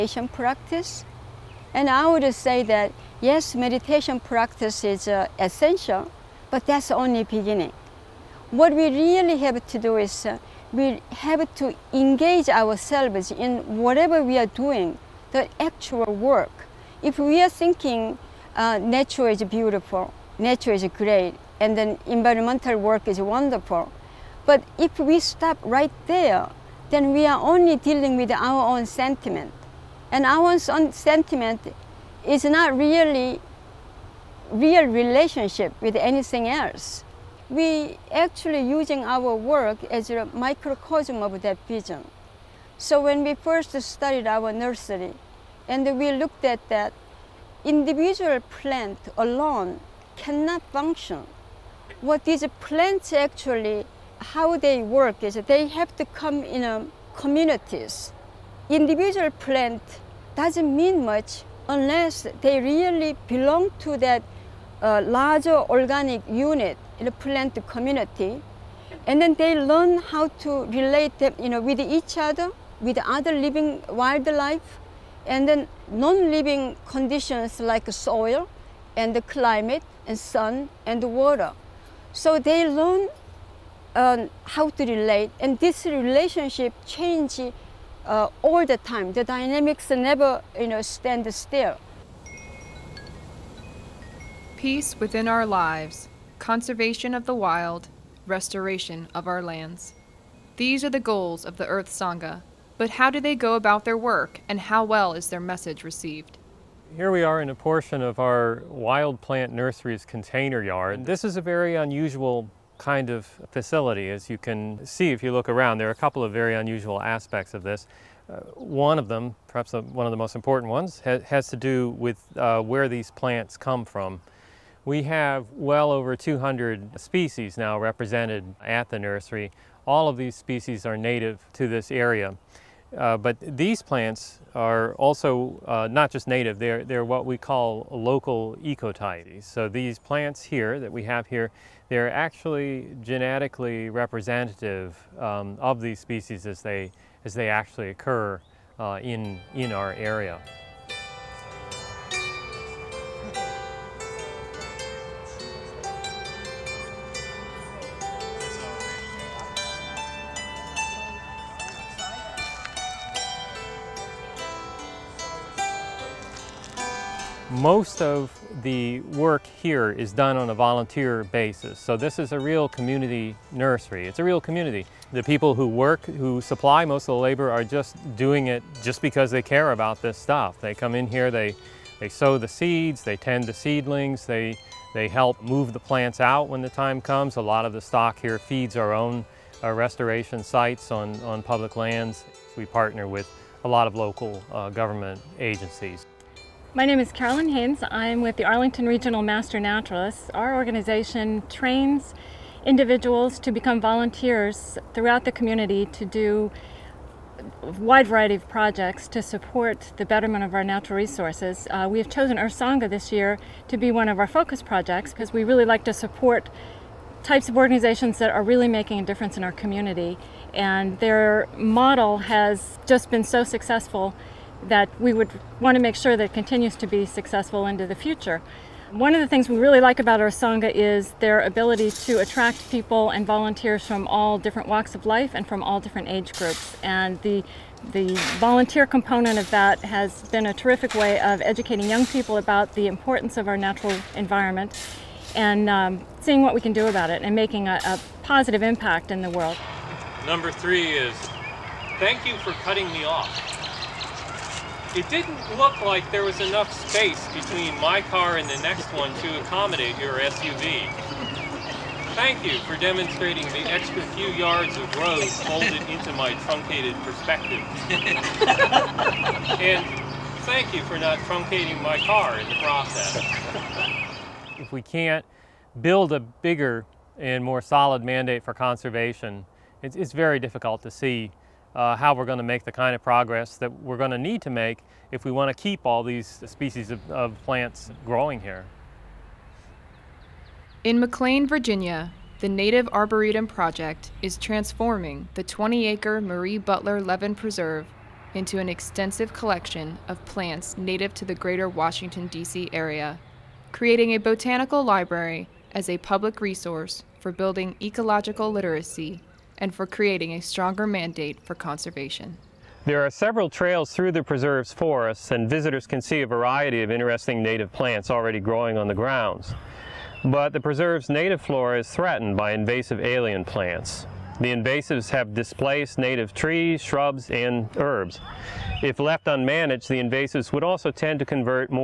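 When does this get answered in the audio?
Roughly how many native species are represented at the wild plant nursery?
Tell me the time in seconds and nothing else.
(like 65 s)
125 s.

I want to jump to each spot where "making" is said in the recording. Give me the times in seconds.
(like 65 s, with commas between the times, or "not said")
218 s, 247 s.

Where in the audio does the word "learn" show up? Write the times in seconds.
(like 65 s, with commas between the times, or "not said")
69 s, 82 s.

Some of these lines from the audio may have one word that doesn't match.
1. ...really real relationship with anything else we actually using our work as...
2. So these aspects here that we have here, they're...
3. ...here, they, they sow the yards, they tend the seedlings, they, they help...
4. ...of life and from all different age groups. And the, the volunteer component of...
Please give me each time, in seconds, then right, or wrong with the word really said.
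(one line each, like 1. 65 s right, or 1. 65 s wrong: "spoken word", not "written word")
1. 32 s right
2. 139 s wrong: "plants", not "aspects"
3. 181 s wrong: "seeds", not "yards"
4. 234 s right.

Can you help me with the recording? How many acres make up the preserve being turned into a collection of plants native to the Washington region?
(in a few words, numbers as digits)
20.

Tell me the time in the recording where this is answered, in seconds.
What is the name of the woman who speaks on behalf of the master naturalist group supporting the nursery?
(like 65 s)
197 s.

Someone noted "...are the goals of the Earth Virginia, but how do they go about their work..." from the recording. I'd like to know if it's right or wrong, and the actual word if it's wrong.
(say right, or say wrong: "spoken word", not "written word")
wrong: "Sangha", not "Virginia".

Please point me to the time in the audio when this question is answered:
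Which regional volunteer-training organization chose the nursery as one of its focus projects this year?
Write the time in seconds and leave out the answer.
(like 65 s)
198 s.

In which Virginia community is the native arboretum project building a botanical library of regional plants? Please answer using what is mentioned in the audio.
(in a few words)
McLean.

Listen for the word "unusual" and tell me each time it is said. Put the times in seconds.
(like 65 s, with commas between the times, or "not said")
111 s, 116 s.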